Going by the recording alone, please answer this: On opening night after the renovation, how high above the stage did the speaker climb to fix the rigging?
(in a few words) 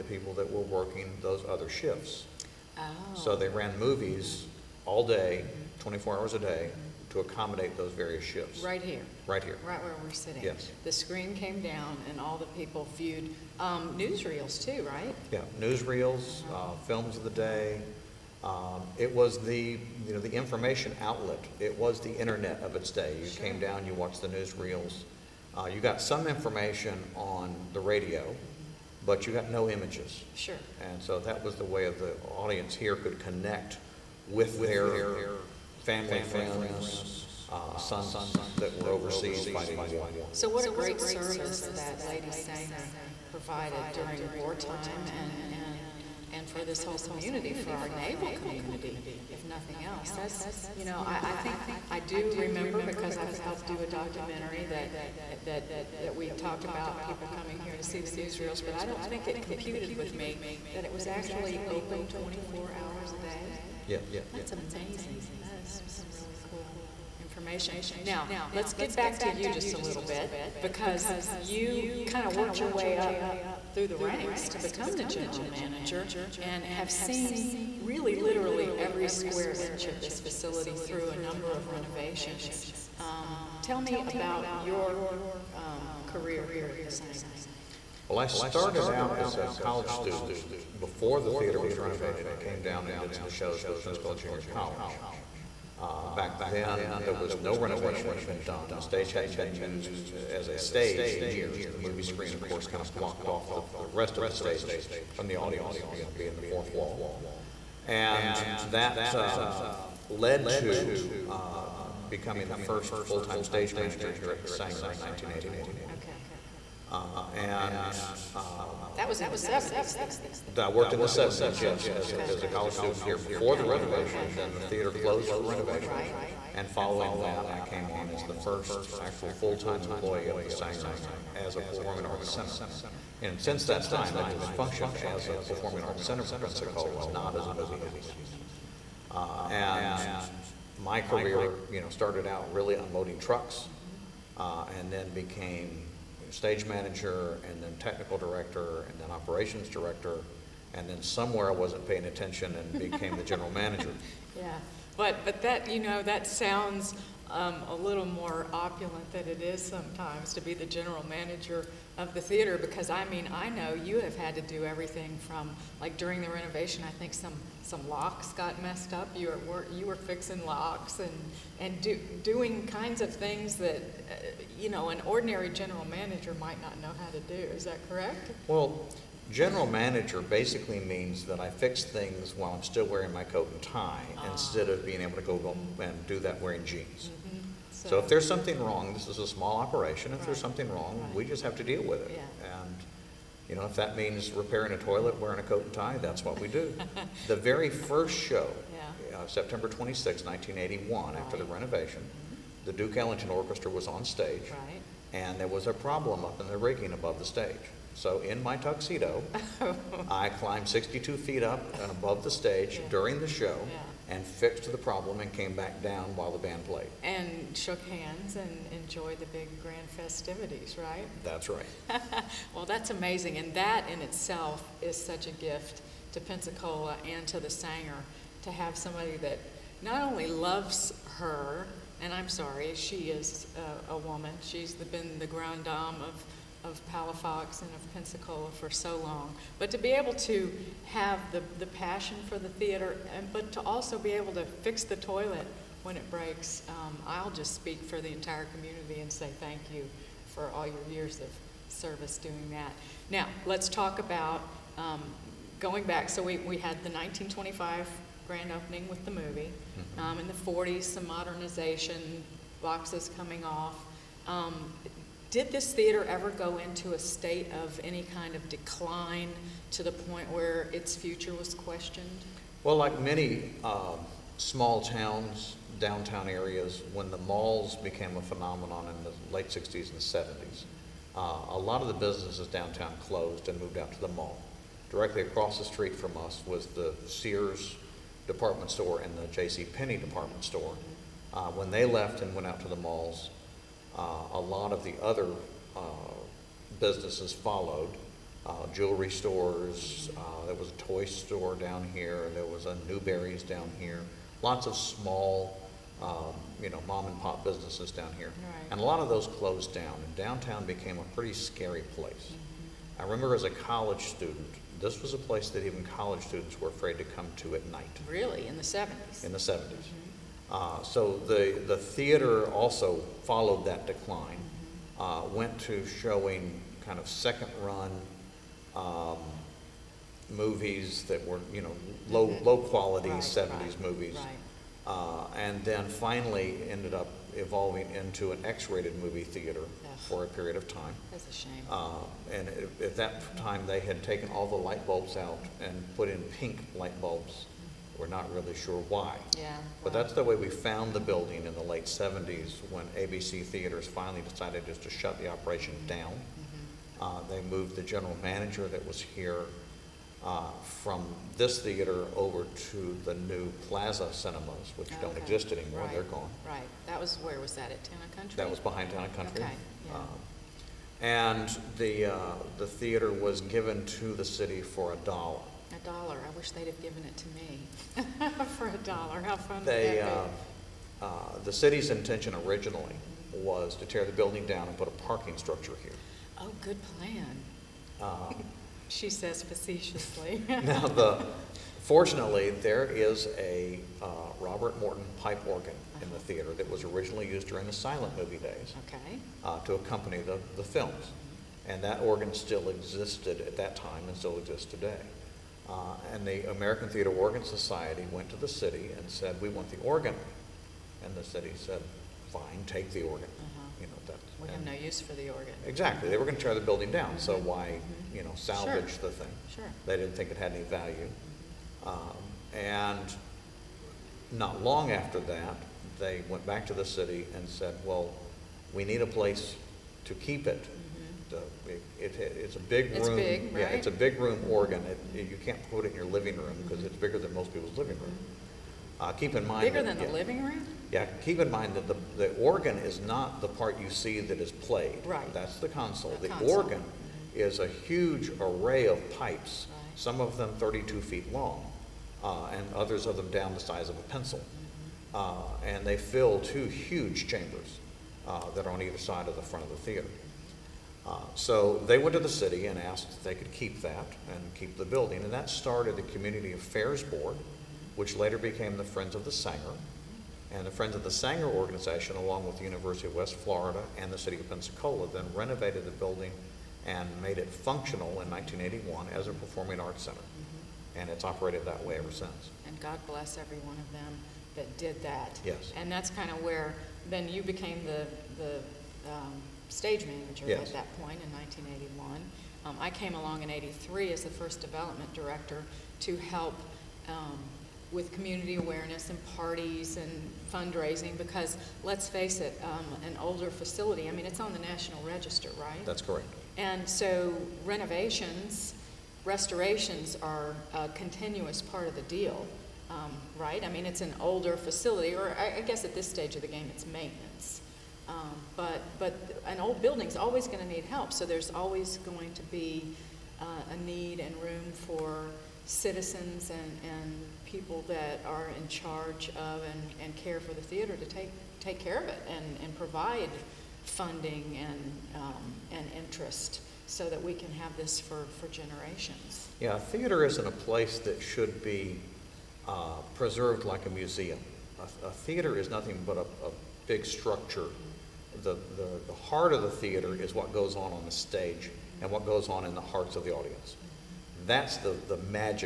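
62 feet.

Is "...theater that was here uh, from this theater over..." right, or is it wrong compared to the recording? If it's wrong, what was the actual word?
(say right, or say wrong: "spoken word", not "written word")
wrong: "manager", not "theater".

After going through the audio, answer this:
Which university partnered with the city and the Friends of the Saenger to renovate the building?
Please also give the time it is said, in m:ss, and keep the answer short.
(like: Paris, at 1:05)
University of West Florida, at 7:52.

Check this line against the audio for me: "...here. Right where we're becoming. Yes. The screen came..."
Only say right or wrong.
wrong.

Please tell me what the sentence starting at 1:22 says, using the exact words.
Um, tell me about your um, career here at the Saenger.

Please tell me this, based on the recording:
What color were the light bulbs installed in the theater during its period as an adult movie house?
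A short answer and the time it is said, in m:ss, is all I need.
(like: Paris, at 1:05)
Pink, at 5:46.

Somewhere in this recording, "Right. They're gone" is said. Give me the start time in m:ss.
6:05.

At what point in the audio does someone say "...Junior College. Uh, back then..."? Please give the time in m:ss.
1:34.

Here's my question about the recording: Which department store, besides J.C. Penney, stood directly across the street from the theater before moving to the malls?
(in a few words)
Sears.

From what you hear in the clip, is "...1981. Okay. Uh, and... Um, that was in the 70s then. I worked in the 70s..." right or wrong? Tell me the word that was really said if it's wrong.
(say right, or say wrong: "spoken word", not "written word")
right.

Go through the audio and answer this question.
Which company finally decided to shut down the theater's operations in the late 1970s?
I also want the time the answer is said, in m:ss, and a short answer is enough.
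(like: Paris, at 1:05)
ABC Theaters, at 5:52.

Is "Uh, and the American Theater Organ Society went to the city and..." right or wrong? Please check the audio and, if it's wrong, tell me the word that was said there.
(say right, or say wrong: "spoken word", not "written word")
right.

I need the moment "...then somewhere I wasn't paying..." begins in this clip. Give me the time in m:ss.
2:30.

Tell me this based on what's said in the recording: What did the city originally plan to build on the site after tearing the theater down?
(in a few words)
A parking structure.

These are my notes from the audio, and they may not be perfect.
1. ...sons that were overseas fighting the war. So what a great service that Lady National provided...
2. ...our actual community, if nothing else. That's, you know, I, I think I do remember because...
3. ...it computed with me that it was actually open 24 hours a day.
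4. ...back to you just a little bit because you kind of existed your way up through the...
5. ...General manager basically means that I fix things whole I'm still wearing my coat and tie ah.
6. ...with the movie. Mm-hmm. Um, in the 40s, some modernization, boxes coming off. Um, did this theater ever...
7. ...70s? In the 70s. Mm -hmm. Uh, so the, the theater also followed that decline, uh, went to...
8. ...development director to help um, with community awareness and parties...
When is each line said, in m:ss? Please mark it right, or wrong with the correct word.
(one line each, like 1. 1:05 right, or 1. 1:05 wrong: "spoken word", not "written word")
1. 0:37 wrong: "Saenger", not "National"
2. 0:47 wrong: "naval", not "actual"
3. 0:59 right
4. 1:08 wrong: "worked", not "existed"
5. 2:59 wrong: "while", not "whole"
6. 4:18 right
7. 5:18 right
8. 8:14 right.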